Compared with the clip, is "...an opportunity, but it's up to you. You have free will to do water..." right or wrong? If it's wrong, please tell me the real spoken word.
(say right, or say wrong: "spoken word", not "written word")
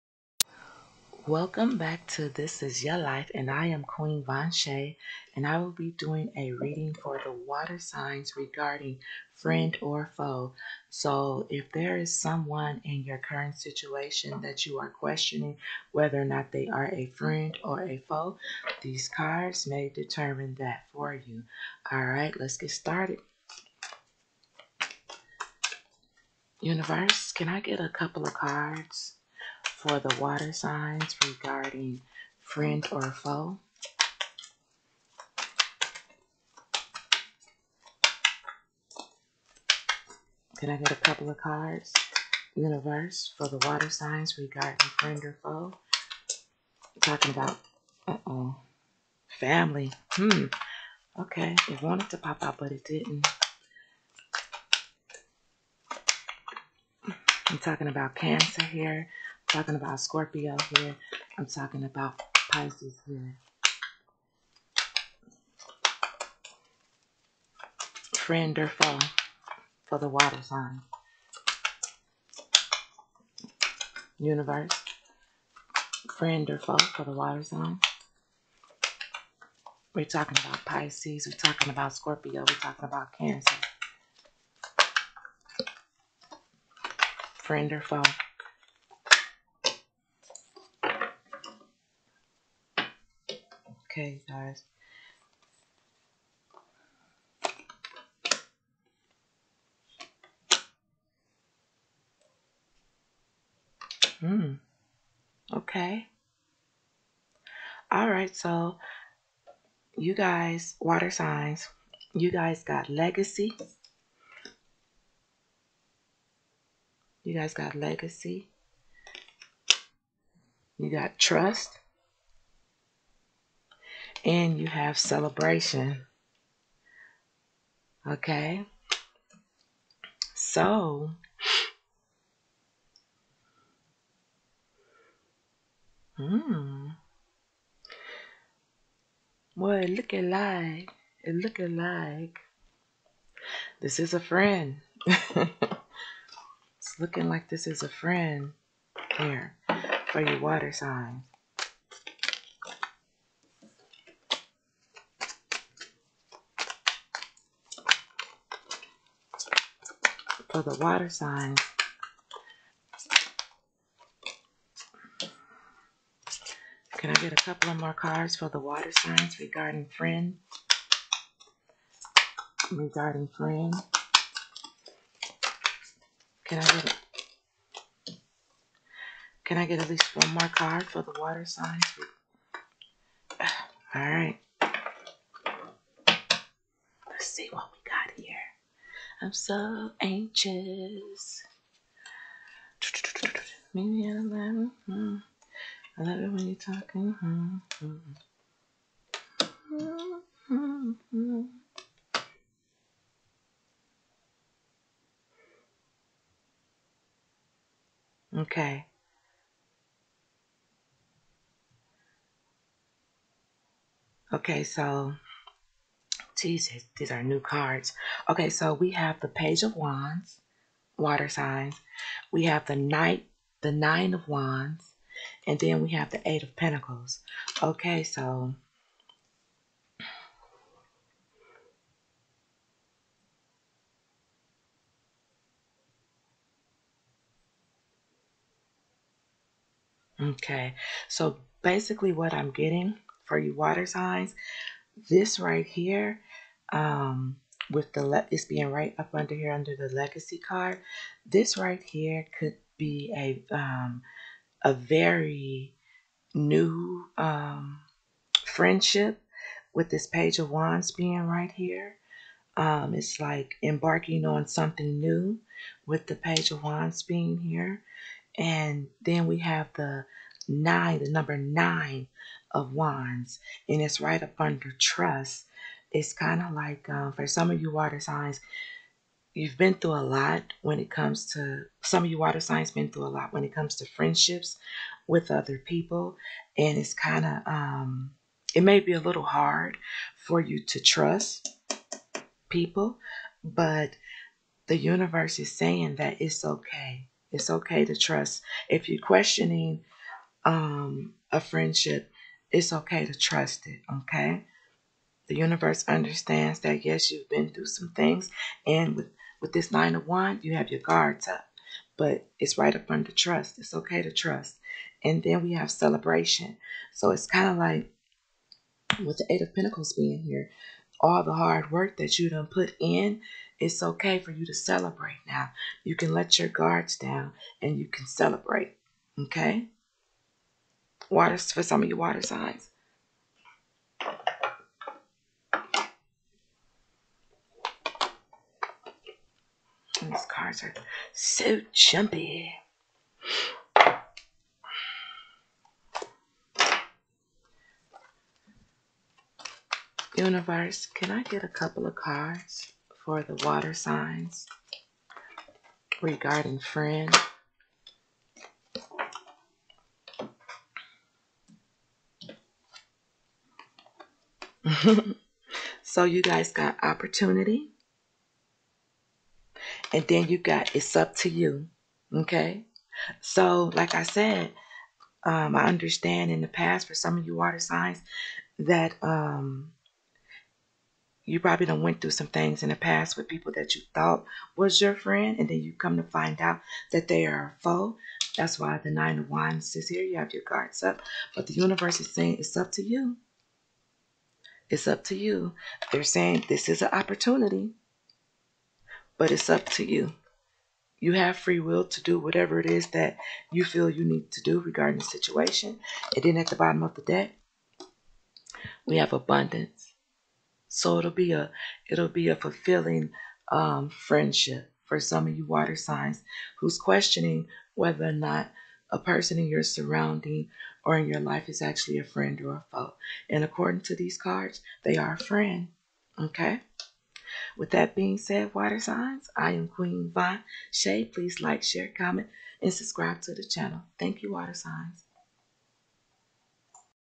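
wrong: "whatever", not "water".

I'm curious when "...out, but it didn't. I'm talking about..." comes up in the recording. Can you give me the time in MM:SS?
00:52.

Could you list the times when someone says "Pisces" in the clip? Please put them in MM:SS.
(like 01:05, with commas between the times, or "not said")
01:02, 01:20.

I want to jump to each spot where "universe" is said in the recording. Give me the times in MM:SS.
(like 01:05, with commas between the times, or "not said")
00:26, 00:42, 01:14, 04:54, 05:05, 05:50, 06:31.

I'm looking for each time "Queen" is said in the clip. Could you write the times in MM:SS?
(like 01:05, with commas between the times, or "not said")
00:03, 07:09.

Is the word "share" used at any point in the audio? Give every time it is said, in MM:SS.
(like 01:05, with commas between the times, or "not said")
07:11.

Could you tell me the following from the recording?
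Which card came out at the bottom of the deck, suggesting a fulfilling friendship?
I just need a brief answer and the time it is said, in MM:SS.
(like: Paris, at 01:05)
Abundance, at 06:49.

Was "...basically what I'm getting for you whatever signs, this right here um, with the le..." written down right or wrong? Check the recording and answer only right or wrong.
wrong.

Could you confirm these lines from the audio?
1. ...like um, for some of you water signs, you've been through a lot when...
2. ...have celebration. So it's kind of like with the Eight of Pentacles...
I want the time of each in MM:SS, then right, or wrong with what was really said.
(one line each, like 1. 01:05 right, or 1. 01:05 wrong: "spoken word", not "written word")
1. 04:36 right
2. 05:15 right.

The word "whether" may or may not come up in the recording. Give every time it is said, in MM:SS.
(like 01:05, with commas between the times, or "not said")
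00:15, 06:57.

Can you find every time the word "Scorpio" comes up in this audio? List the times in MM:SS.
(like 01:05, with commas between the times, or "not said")
00:59, 01:21.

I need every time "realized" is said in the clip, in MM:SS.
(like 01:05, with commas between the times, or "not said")
not said.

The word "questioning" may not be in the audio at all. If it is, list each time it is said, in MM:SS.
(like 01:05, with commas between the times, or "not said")
00:14, 04:59, 06:56.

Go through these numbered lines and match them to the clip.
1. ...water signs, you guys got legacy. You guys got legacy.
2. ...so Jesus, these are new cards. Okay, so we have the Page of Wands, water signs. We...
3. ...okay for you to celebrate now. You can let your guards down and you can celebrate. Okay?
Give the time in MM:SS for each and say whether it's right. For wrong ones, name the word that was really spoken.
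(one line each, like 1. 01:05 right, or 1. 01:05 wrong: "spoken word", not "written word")
1. 01:50 right
2. 03:34 right
3. 05:23 right.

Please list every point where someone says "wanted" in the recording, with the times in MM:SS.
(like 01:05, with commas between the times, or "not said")
00:51.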